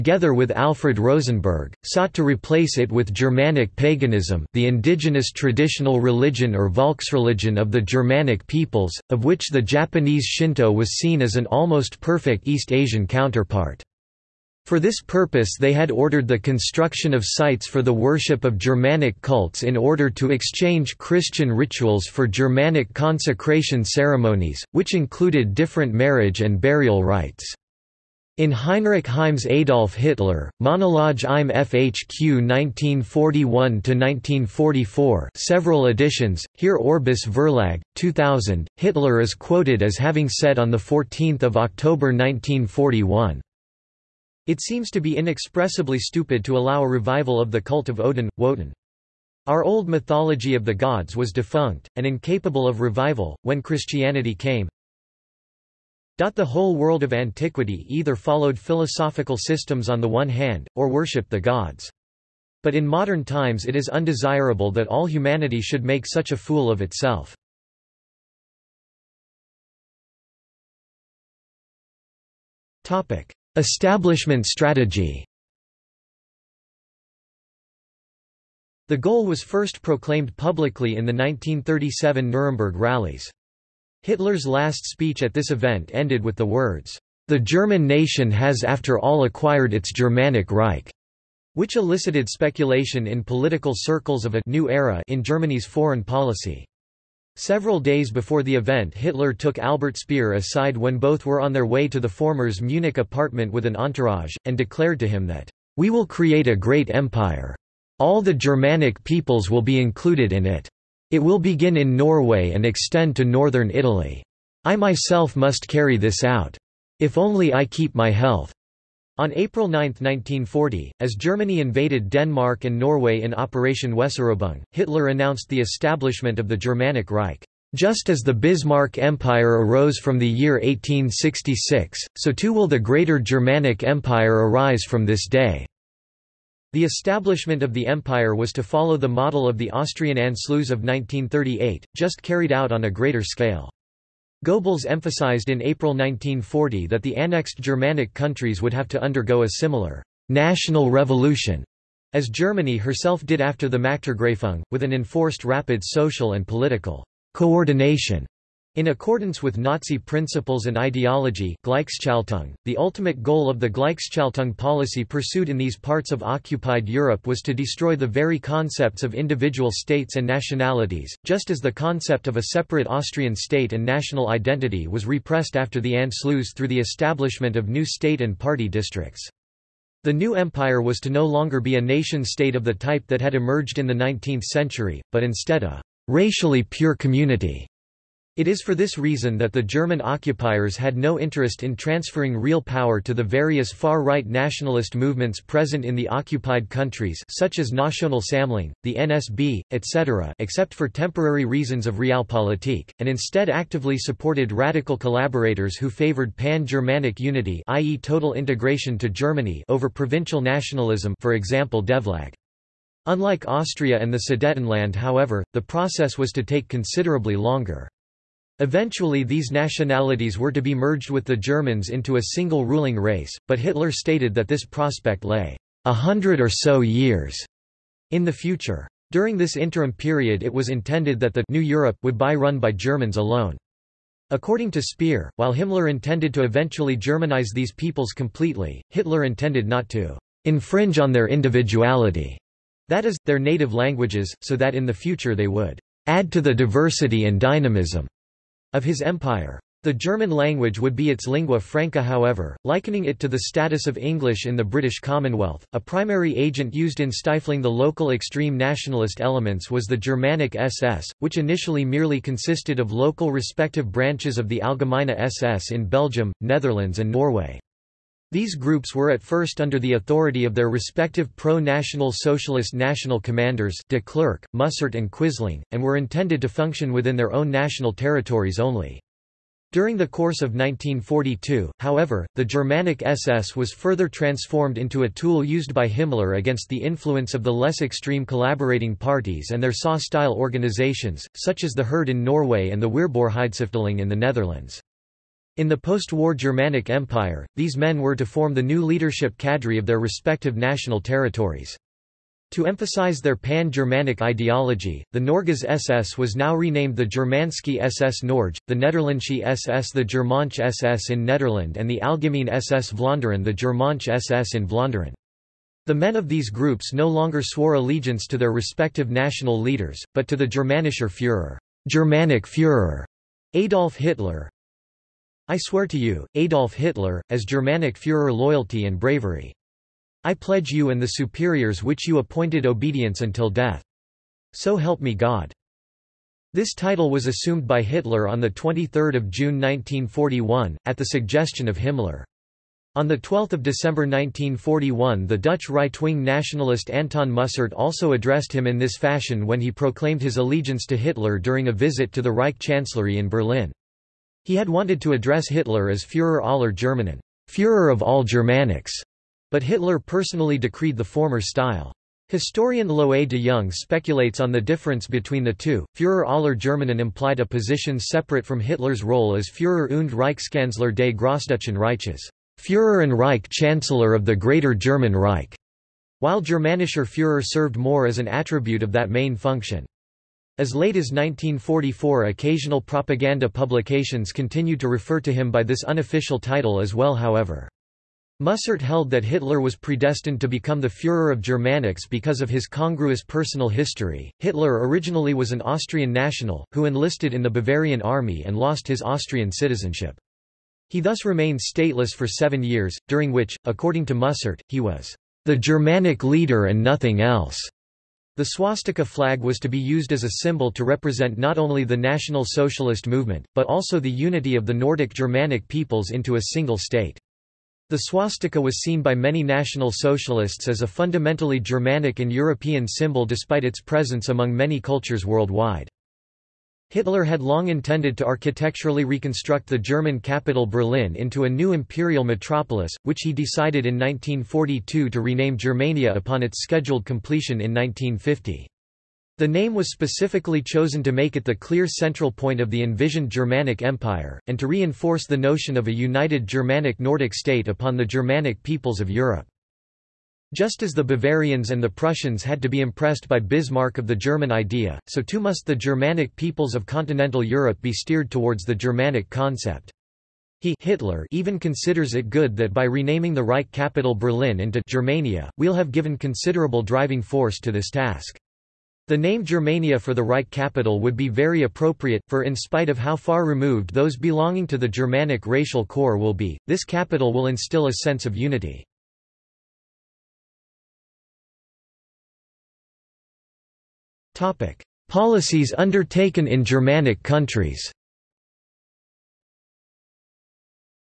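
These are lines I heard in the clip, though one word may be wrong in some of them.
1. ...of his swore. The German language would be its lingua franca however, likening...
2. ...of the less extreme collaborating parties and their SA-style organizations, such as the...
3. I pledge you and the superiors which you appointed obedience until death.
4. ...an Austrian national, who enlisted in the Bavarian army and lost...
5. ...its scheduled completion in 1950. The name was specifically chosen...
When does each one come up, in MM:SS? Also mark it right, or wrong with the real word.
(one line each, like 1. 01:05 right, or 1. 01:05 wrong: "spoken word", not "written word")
1. 04:08 wrong: "empire", not "swore"
2. 04:47 right
3. 05:30 right
4. 06:35 right
5. 07:16 right.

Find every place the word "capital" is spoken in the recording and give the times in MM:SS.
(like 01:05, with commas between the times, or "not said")
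07:10, 07:43, 07:50, 07:56.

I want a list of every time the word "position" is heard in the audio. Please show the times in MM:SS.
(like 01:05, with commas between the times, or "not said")
06:07.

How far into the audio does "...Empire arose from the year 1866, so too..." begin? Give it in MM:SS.
02:08.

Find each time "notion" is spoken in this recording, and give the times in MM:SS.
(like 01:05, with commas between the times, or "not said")
07:25.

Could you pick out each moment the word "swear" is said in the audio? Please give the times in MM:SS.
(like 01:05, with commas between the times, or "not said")
05:25.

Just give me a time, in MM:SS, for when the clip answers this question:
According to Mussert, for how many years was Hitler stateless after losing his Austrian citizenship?
06:42.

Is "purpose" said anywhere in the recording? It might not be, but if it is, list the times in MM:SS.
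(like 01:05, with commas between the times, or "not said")
00:15.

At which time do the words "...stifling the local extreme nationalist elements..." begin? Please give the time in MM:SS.
04:17.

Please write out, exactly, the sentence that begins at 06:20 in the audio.
As late as 1944 occasional propaganda publications continued to refer to him by this unofficial title as well however.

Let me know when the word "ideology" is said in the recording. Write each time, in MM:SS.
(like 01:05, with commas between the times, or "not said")
02:40, 05:04.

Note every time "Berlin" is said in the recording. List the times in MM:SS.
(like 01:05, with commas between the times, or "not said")
05:53, 07:10, 07:44.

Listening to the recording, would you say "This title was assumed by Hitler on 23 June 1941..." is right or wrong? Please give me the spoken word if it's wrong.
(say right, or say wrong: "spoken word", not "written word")
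right.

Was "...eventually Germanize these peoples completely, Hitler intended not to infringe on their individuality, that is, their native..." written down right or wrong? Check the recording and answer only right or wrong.
right.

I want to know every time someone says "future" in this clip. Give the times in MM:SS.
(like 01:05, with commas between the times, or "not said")
03:48, 04:04.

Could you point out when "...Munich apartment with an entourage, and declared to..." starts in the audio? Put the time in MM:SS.
01:42.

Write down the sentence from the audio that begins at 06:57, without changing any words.
The swastika was seen by many National Socialists as a fundamentally Germanic and European symbol despite its presence among many cultures worldwide.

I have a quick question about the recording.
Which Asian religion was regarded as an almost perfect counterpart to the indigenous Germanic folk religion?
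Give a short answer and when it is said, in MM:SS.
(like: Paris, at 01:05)
Shinto, at 00:09.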